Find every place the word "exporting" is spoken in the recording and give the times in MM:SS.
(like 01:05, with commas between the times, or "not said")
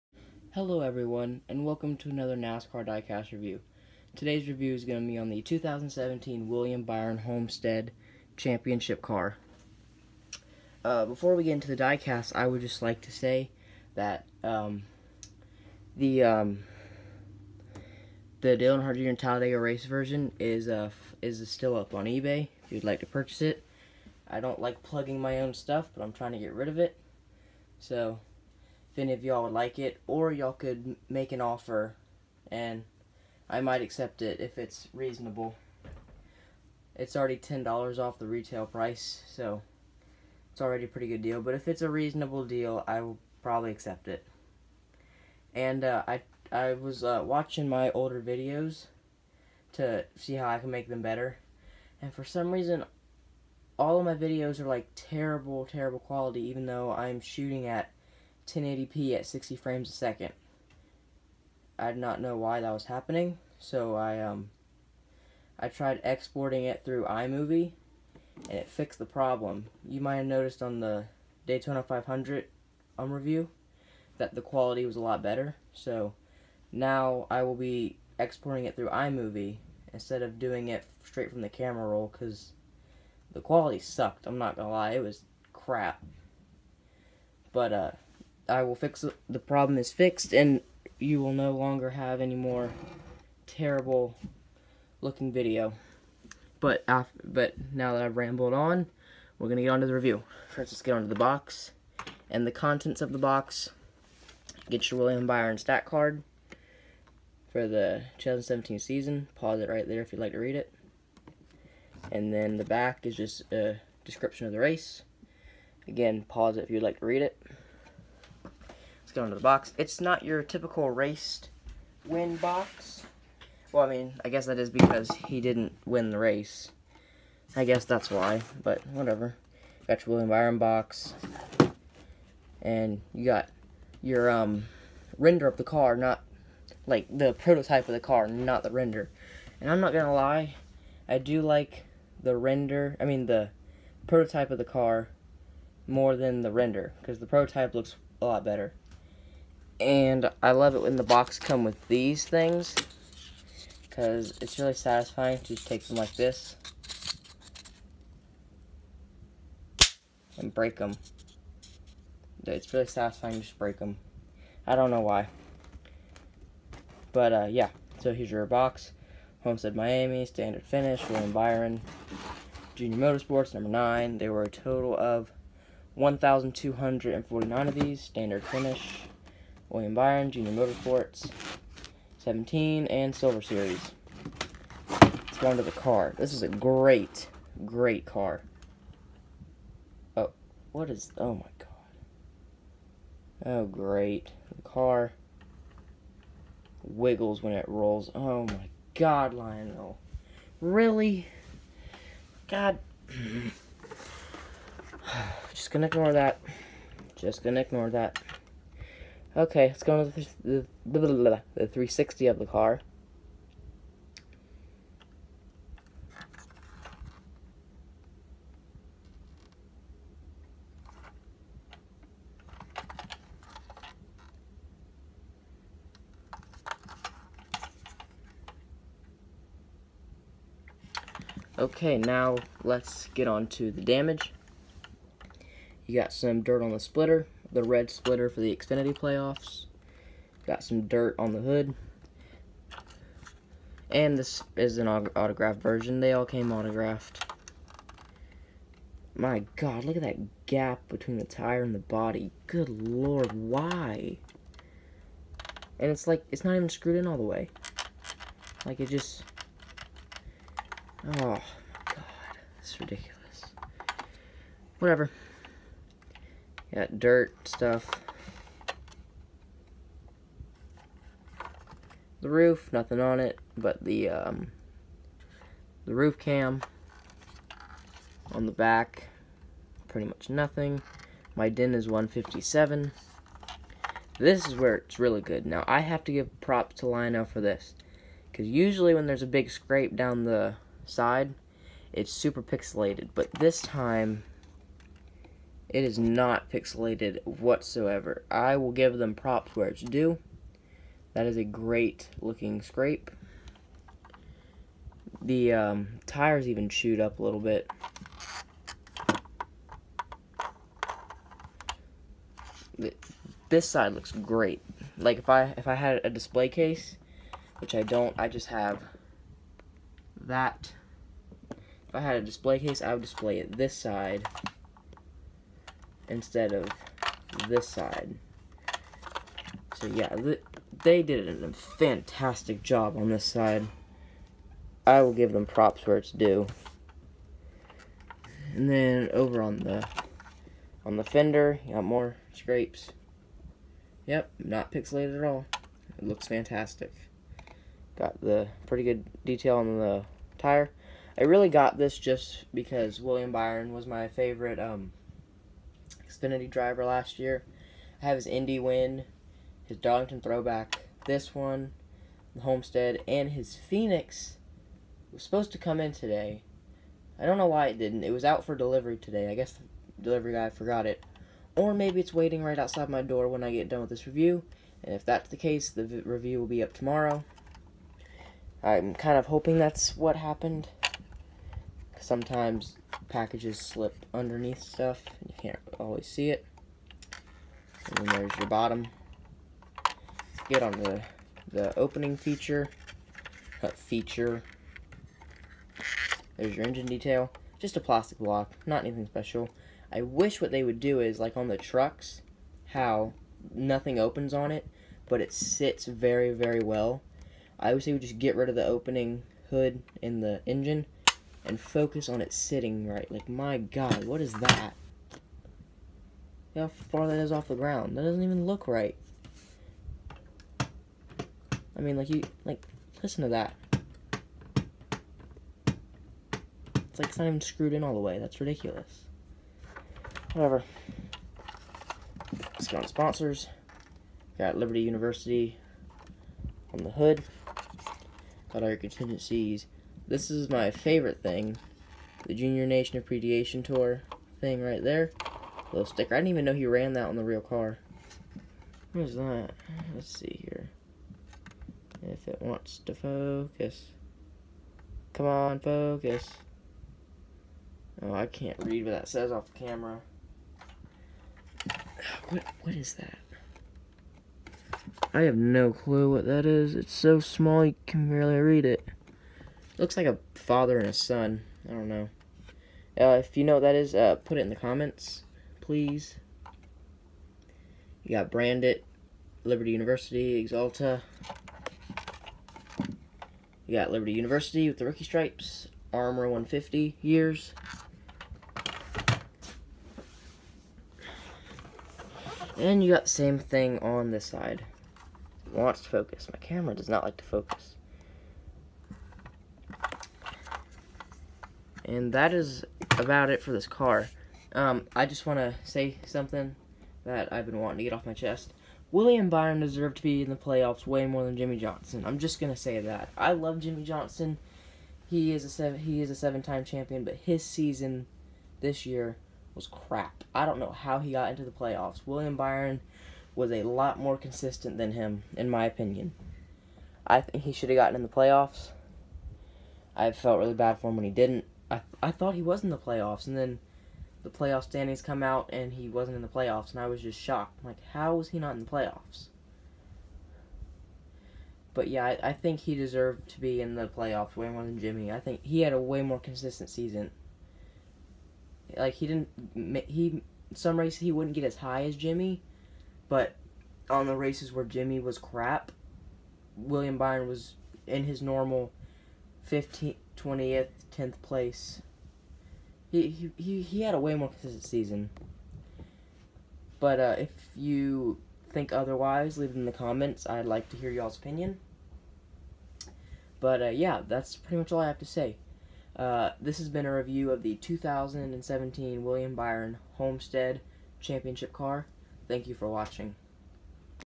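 01:06, 01:18.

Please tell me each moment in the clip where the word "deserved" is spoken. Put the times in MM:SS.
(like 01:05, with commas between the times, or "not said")
08:29, 09:02.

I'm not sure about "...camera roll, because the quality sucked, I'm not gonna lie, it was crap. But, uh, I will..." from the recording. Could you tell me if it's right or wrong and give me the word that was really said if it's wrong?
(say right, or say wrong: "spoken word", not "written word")
right.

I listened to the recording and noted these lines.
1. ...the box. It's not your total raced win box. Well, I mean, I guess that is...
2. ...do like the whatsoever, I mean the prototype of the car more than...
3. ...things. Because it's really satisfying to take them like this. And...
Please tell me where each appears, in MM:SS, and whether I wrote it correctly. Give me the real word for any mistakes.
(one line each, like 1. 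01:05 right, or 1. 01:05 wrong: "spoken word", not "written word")
1. 01:59 wrong: "typical", not "total"
2. 02:21 wrong: "render", not "whatsoever"
3. 02:32 right.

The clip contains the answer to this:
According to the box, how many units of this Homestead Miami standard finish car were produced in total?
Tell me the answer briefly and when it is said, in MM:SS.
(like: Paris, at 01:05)
1,249, at 02:55.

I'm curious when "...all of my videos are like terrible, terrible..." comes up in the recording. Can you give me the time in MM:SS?
00:53.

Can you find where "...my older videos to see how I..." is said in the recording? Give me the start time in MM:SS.
00:47.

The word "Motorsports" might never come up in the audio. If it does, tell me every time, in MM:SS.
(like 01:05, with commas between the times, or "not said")
02:52, 03:00.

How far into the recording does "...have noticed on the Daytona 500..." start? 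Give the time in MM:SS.
01:10.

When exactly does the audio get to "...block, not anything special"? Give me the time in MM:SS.
06:38.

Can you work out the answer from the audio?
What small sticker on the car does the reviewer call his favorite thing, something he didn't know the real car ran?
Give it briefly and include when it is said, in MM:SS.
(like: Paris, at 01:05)
Junior Nation Appreciation Tour, at 07:22.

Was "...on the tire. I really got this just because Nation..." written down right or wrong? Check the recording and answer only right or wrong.
wrong.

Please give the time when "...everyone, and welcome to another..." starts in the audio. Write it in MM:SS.
00:00.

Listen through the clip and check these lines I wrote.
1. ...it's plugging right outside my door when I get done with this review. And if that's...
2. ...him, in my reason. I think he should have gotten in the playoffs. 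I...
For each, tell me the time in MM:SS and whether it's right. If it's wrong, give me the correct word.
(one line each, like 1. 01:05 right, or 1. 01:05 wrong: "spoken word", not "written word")
1. 06:11 wrong: "waiting", not "plugging"
2. 08:44 wrong: "opinion", not "reason".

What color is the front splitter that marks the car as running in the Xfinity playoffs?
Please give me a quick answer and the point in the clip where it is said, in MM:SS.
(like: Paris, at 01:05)
Red, at 03:57.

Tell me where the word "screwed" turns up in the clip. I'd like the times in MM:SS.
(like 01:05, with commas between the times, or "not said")
04:16, 07:07.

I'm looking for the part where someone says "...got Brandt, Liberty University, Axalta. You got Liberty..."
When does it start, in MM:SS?
07:58.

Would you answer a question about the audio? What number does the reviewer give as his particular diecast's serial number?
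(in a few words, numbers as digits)
157.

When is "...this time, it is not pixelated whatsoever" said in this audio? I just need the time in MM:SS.
04:53.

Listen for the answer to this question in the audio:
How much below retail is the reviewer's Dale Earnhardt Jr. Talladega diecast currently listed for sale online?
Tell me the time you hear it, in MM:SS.
00:37.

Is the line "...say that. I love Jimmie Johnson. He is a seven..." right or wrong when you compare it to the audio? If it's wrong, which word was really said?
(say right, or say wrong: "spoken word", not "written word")
right.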